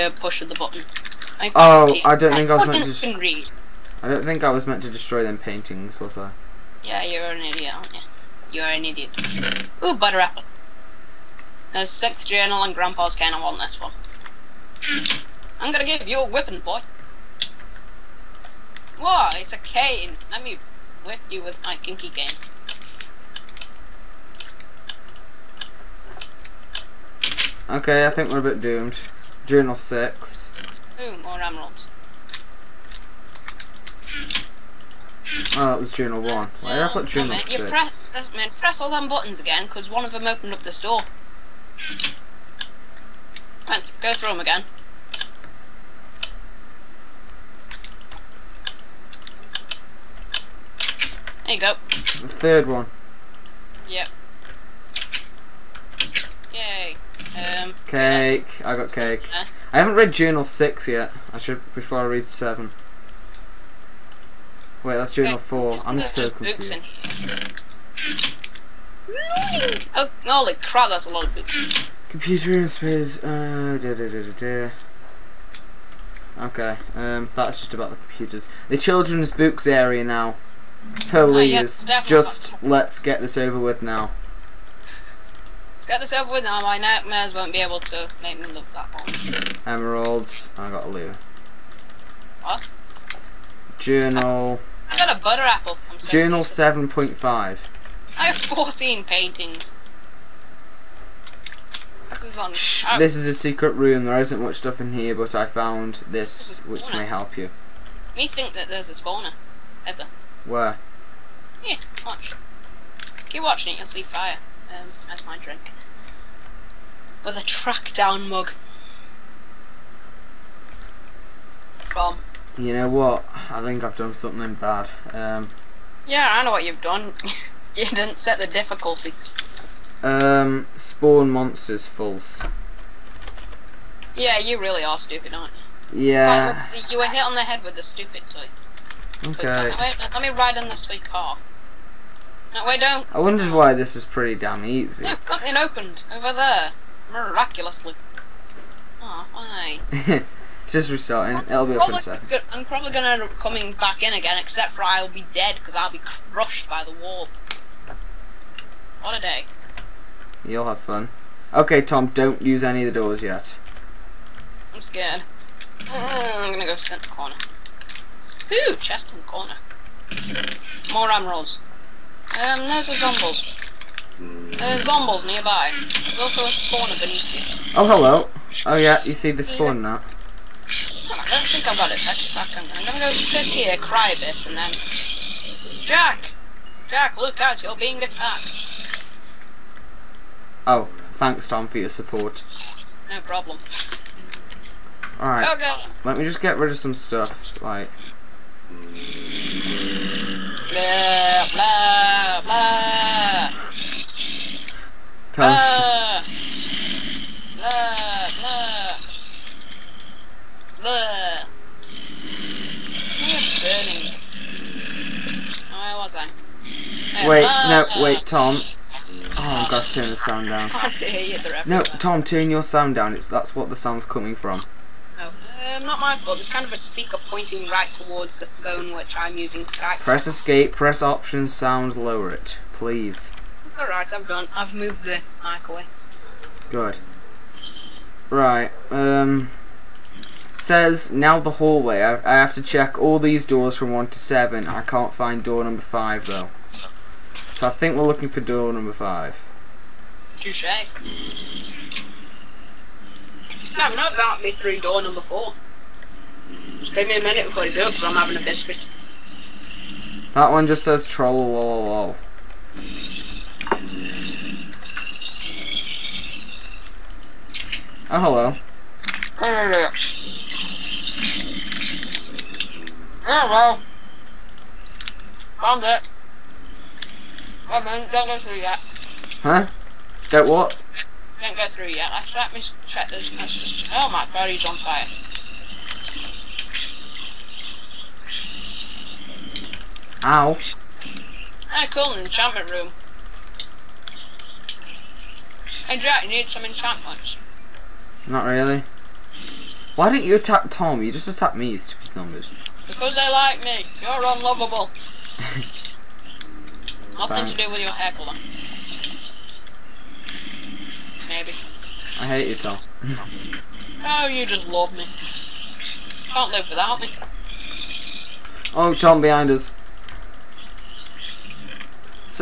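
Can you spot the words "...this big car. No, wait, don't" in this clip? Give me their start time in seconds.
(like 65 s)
140 s.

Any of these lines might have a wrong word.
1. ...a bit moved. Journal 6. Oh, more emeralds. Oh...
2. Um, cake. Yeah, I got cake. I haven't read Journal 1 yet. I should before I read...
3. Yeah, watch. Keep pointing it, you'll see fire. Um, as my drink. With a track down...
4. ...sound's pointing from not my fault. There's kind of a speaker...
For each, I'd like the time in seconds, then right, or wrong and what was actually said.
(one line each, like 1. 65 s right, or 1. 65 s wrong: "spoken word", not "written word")
1. 28 s wrong: "doomed", not "moved"
2. 57 s wrong: "6", not "1"
3. 111 s wrong: "watching", not "pointing"
4. 223 s wrong: "coming", not "pointing".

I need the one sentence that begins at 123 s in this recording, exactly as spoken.
I think I've done something bad.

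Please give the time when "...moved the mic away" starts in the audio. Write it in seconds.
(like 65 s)
234 s.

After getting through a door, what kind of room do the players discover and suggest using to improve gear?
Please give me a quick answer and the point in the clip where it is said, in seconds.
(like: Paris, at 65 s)
Enchantment room, at 292 s.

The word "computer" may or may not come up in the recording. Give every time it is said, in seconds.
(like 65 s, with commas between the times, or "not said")
72 s, 77 s.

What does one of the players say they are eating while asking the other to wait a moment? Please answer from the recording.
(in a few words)
A biscuit.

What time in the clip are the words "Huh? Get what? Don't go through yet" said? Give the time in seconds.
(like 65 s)
279 s.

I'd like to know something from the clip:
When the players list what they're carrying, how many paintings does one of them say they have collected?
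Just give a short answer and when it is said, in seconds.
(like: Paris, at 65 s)
14, at 98 s.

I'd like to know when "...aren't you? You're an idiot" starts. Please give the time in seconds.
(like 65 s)
7 s.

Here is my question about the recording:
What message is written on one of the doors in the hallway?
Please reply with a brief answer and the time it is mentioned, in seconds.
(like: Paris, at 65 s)
trollololol, at 261 s.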